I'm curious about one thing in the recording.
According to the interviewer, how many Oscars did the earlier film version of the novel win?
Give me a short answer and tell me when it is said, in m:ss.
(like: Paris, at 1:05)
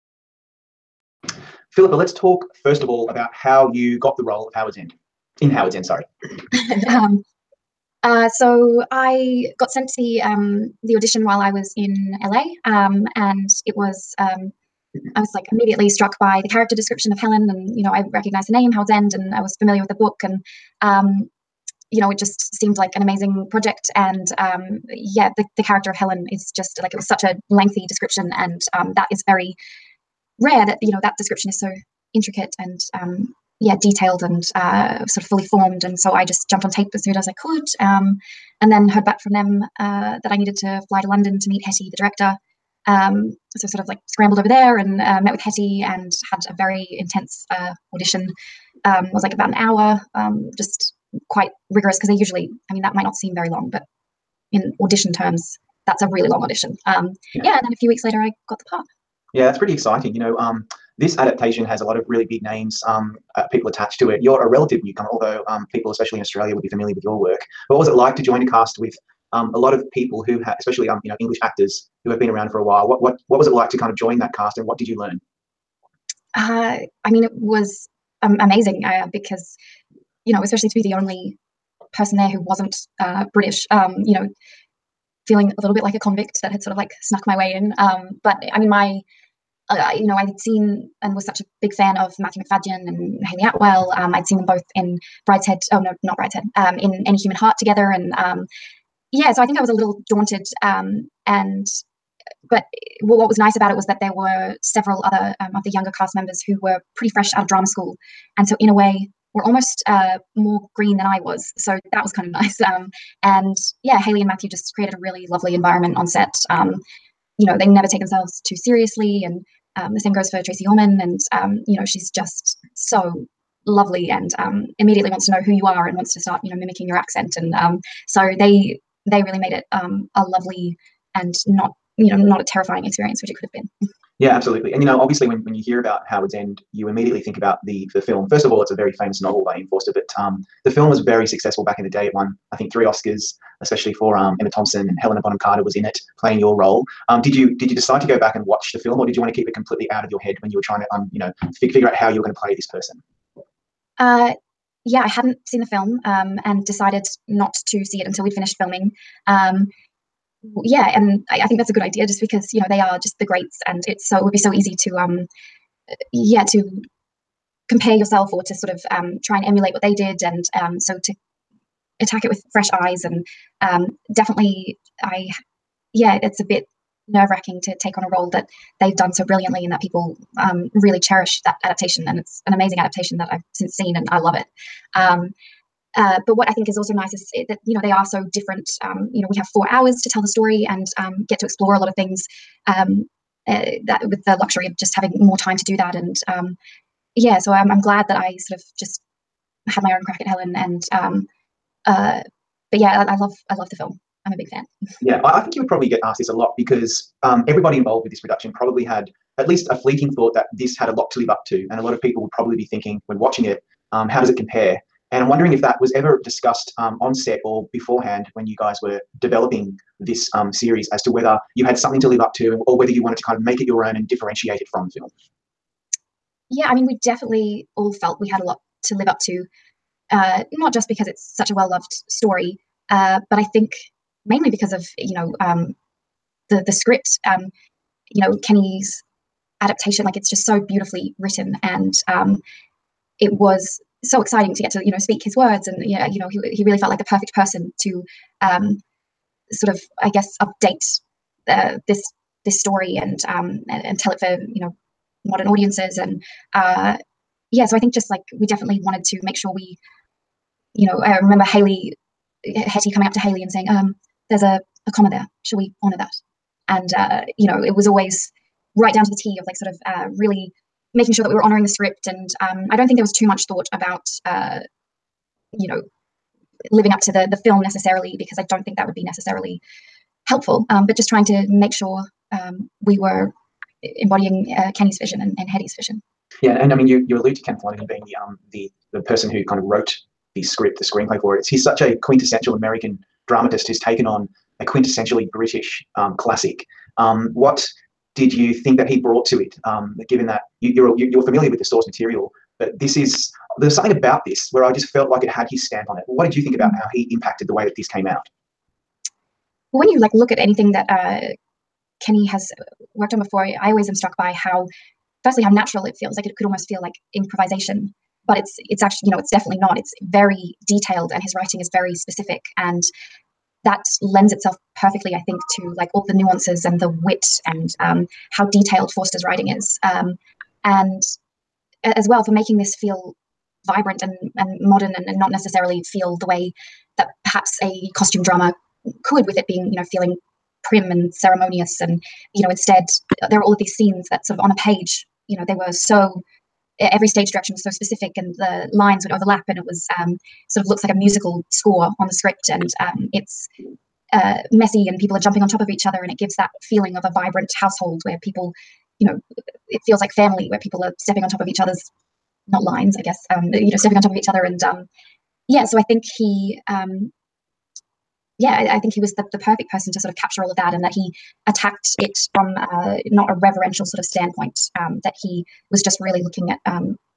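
3, at 2:22.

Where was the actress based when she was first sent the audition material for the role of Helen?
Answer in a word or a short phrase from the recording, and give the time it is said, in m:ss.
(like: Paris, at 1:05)
LA, at 0:12.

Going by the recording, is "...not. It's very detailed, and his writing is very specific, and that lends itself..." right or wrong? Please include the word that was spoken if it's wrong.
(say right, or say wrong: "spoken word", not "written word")
right.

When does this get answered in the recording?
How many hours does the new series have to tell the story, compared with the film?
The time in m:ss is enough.
3:09.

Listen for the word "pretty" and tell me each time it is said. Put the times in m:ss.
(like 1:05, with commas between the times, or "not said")
0:59, 1:46.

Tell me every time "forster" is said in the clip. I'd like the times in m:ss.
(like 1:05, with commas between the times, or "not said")
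2:19, 5:28.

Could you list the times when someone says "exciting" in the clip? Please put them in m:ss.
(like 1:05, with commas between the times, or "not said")
0:59, 4:04.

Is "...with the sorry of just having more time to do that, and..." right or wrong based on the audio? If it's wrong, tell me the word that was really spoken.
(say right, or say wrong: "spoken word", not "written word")
wrong: "luxury", not "sorry".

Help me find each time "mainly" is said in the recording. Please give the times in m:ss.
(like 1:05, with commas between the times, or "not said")
3:54.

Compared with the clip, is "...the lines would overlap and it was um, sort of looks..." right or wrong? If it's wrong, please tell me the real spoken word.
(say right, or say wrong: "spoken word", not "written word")
right.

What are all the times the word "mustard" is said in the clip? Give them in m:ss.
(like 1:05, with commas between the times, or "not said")
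not said.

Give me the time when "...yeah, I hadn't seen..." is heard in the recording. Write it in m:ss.
2:34.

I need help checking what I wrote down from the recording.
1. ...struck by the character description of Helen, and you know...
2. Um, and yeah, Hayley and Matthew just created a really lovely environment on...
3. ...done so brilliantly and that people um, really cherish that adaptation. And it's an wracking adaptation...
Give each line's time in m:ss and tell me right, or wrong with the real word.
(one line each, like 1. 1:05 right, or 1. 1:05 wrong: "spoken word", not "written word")
1. 0:15 right
2. 1:52 right
3. 2:58 wrong: "amazing", not "wracking".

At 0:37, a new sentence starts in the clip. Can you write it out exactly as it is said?
Um, and then heard back from them uh, that I needed to fly to London to meet Hettie, the director.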